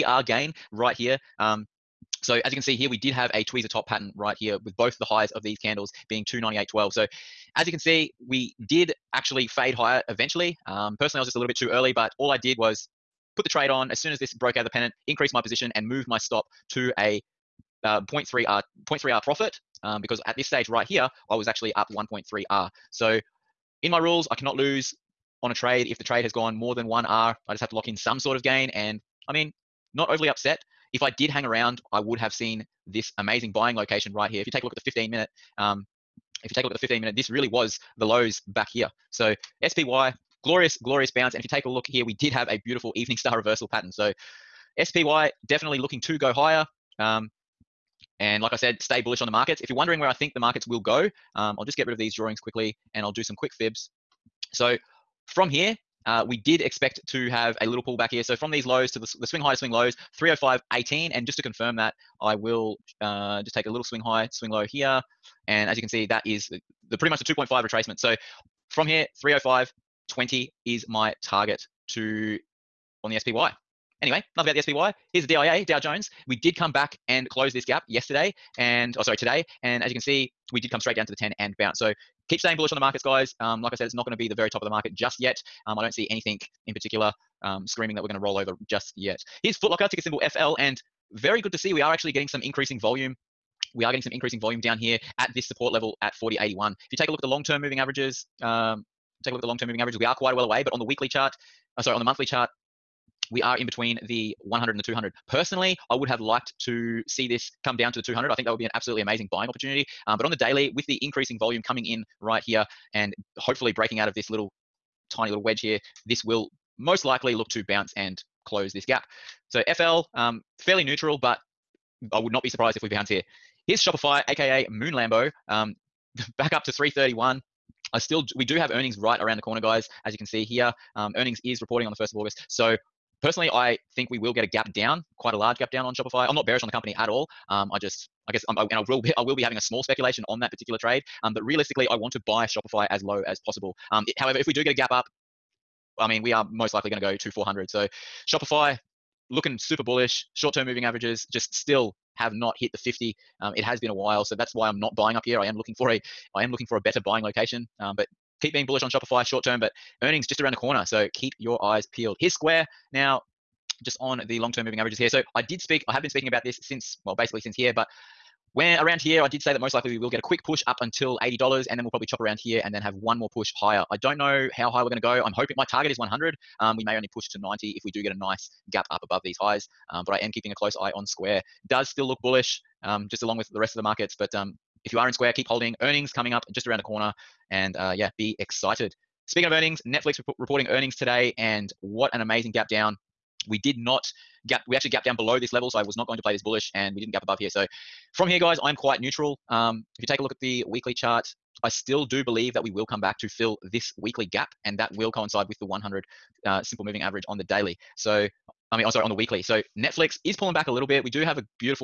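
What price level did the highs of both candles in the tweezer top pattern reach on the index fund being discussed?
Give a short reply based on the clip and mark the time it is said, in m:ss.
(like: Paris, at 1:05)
298.12, at 0:06.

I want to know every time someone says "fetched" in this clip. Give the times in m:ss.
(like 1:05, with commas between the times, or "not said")
not said.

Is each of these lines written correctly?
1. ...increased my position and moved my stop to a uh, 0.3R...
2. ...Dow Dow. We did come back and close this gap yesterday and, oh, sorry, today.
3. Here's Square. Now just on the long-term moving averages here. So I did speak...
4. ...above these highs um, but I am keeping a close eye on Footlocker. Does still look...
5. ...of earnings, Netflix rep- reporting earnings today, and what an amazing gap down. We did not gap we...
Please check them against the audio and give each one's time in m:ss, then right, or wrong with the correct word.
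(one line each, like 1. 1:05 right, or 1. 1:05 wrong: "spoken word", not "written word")
1. 0:15 right
2. 1:15 wrong: "Jones", not "Dow"
3. 2:42 right
4. 2:59 wrong: "Square", not "Footlocker"
5. 3:09 right.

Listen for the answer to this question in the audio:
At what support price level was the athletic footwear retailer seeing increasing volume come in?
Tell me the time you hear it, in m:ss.
1:36.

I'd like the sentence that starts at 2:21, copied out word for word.
Um, but realistically, I want to buy Shopify as low as possible.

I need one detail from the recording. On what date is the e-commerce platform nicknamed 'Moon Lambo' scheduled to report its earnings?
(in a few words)
1st of August.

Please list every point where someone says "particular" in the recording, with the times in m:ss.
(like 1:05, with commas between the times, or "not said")
1:26, 2:20.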